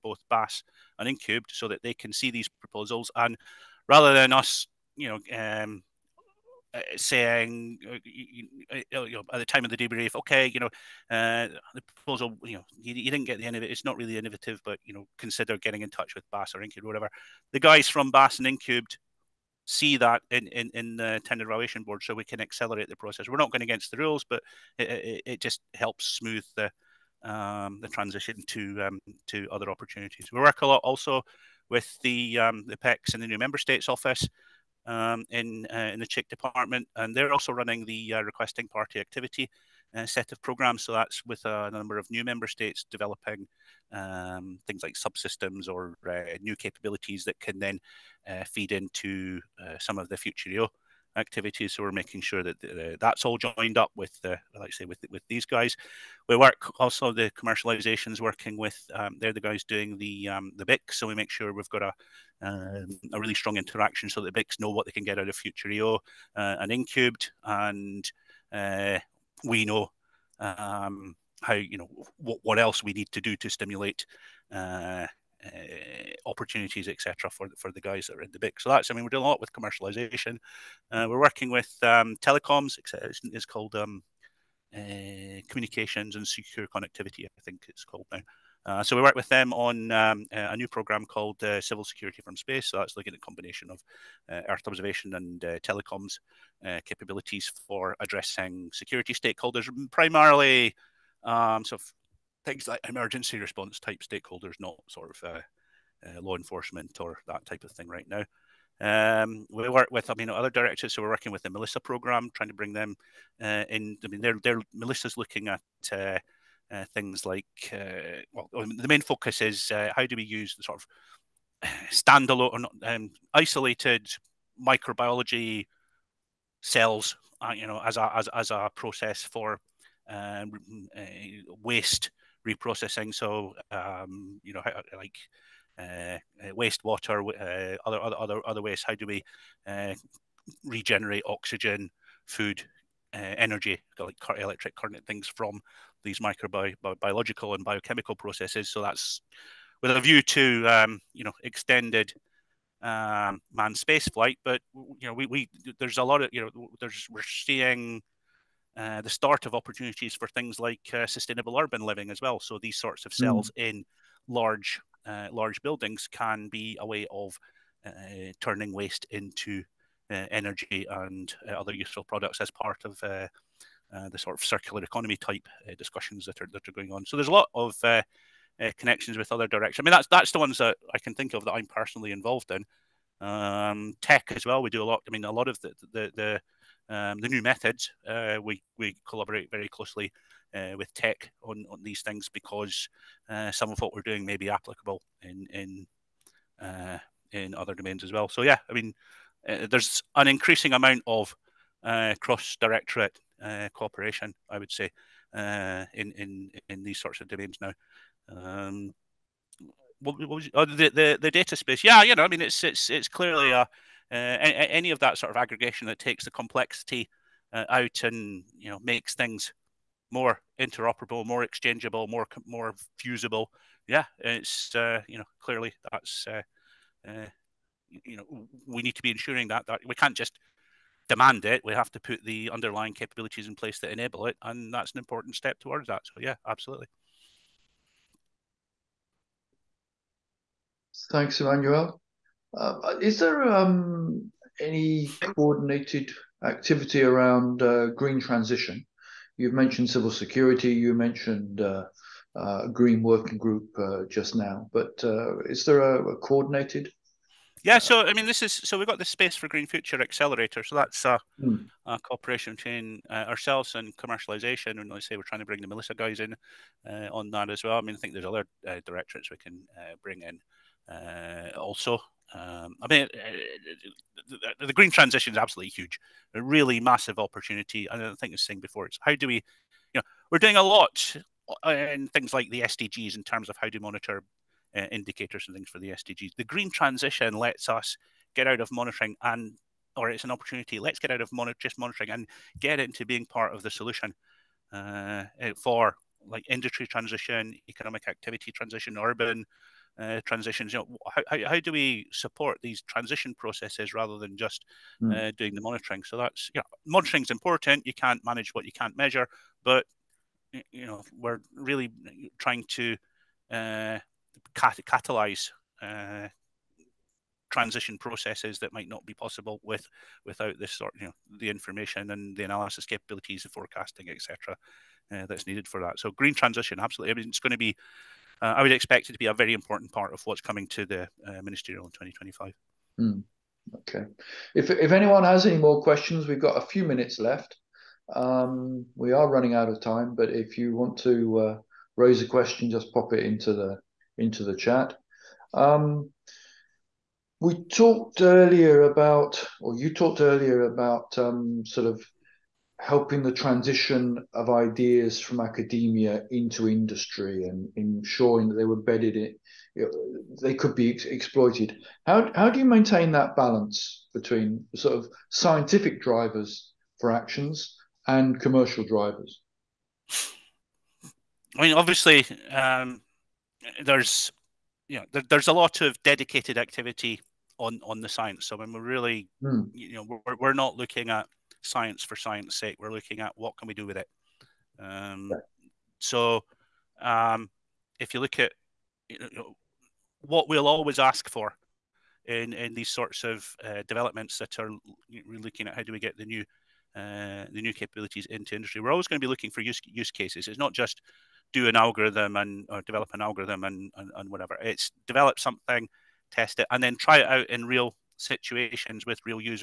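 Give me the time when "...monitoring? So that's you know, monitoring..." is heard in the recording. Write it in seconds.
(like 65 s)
305 s.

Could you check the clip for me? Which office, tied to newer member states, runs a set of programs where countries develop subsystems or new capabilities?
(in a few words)
PECS.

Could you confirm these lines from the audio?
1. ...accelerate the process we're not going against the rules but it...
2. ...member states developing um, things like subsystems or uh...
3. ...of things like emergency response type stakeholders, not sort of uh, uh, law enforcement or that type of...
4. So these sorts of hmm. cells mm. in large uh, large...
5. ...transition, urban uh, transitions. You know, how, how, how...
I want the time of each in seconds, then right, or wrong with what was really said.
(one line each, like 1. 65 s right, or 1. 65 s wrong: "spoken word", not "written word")
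1. 22 s right
2. 42 s right
3. 101 s right
4. 162 s right
5. 298 s right.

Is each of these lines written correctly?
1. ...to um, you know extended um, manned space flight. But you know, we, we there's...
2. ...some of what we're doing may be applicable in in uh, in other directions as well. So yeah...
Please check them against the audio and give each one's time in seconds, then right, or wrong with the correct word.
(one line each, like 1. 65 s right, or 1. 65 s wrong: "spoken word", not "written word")
1. 150 s right
2. 193 s wrong: "domains", not "directions".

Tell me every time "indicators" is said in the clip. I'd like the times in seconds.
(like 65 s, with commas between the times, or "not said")
284 s.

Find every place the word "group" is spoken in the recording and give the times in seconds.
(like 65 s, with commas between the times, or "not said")
253 s.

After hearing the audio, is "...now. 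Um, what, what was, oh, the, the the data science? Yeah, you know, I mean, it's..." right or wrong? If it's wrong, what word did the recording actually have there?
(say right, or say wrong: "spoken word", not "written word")
wrong: "space", not "science".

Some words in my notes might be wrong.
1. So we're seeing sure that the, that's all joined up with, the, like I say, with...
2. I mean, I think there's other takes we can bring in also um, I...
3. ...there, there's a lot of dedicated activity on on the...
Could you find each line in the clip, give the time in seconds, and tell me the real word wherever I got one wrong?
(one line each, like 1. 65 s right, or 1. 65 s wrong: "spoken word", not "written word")
1. 51 s wrong: "making", not "seeing"
2. 267 s wrong: "directorates", not "takes"
3. 375 s right.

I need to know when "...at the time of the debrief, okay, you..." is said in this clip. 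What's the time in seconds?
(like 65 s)
9 s.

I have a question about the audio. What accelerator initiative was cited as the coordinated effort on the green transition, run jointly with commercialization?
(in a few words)
Space for Green Future Accelerator.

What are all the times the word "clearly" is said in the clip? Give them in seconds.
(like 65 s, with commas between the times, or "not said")
213 s, 225 s.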